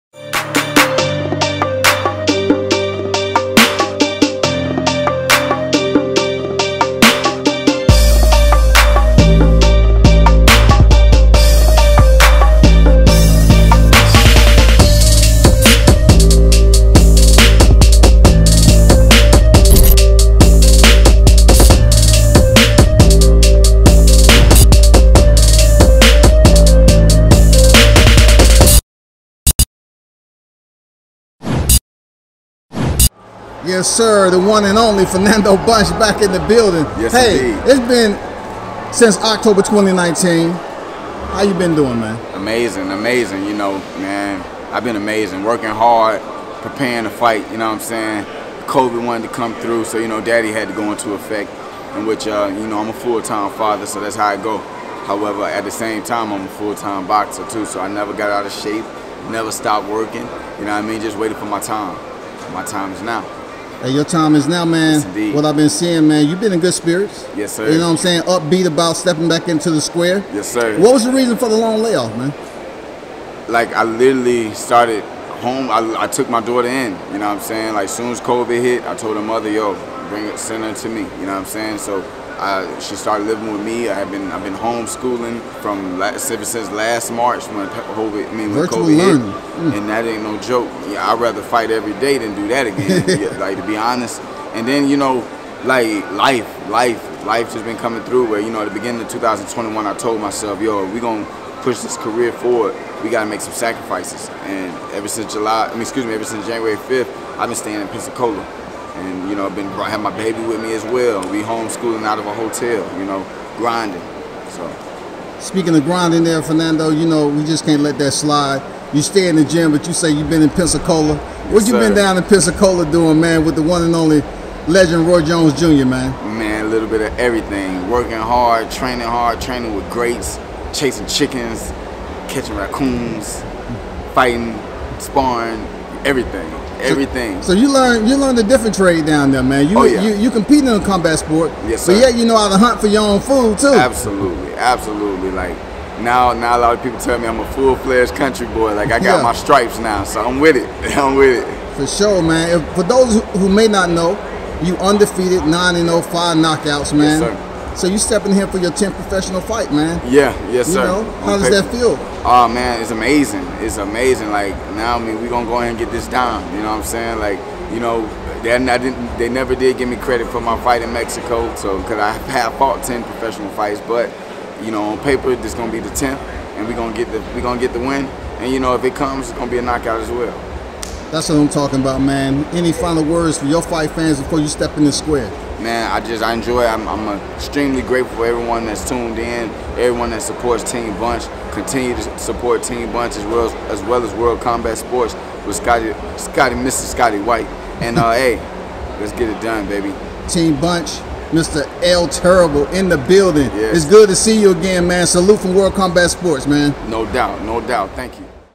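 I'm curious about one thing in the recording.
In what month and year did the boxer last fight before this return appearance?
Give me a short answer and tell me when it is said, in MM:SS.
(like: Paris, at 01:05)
October 2019, at 00:39.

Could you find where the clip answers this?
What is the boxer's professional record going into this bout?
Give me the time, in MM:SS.
02:35.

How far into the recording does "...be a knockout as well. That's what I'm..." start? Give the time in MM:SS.
02:59.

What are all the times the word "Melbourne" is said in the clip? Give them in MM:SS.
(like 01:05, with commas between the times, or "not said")
not said.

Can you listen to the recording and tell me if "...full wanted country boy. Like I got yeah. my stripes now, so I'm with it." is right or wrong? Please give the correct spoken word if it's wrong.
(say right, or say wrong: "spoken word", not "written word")
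wrong: "fledged", not "wanted".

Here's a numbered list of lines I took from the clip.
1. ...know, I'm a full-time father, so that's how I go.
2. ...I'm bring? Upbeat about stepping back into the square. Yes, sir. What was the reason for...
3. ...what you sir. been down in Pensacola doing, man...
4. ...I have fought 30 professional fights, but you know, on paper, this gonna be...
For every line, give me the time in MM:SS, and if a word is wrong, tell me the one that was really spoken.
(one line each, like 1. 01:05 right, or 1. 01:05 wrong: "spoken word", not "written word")
1. 00:52 right
2. 01:07 wrong: "saying", not "bring"
3. 02:01 right
4. 02:51 wrong: "10", not "30".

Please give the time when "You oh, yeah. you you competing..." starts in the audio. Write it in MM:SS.
02:19.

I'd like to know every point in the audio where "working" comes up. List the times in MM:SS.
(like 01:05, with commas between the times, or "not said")
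00:45, 00:59, 02:07.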